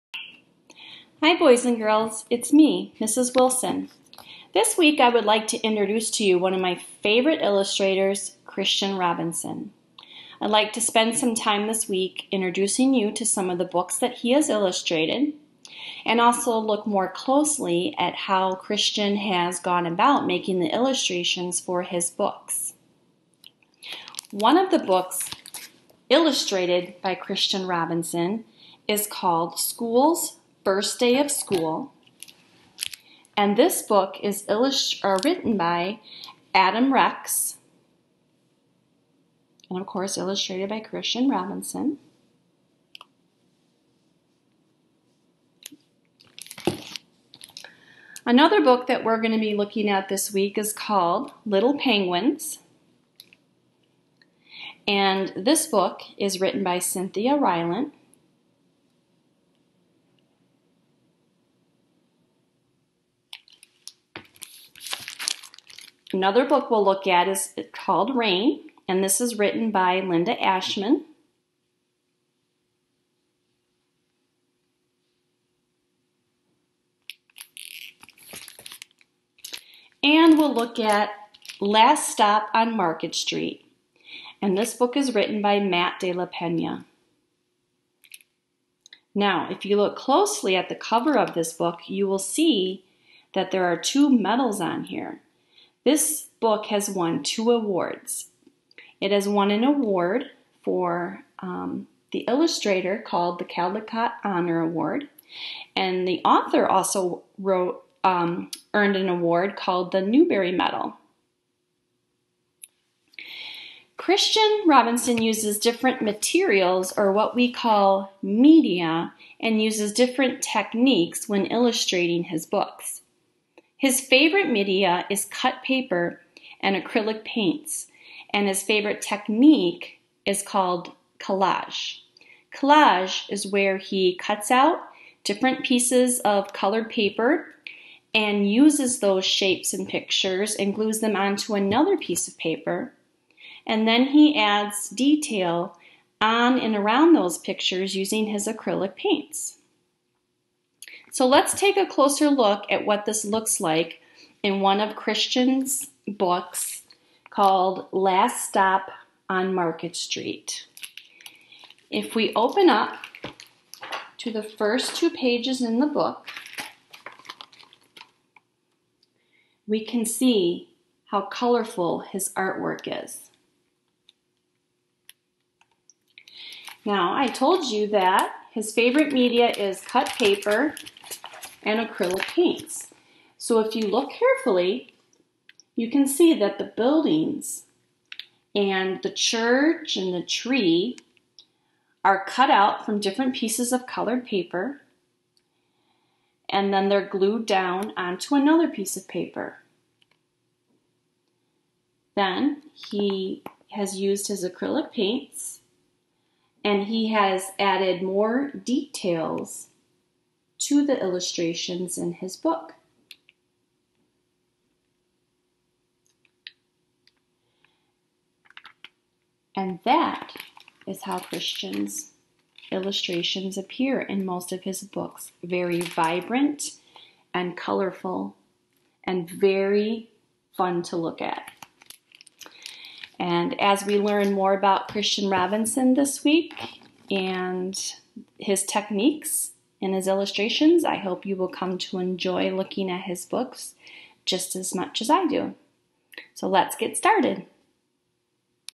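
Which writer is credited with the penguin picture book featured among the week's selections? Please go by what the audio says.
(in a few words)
Cynthia Rylant.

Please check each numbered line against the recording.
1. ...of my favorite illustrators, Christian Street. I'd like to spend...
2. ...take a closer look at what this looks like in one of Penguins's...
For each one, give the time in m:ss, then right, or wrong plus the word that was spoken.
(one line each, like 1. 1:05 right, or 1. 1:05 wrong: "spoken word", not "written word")
1. 0:06 wrong: "Robinson", not "Street"
2. 2:31 wrong: "Christian", not "Penguins".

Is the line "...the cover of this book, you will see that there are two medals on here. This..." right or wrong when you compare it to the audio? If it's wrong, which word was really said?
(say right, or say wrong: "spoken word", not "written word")
right.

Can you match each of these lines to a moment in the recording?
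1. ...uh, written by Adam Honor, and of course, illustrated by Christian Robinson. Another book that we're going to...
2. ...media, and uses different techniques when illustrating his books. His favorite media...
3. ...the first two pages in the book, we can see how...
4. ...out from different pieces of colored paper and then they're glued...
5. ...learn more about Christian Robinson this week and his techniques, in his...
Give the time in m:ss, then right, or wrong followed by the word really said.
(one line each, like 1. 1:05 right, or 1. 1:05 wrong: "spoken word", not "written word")
1. 0:35 wrong: "Rex", not "Honor"
2. 1:58 right
3. 2:44 right
4. 3:12 right
5. 3:53 right.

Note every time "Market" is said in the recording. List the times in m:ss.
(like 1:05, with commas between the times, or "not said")
1:22, 2:39.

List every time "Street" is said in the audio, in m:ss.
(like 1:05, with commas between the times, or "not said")
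1:23, 2:39.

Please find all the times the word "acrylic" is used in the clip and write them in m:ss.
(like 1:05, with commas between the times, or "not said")
2:06, 2:28, 3:01, 3:24.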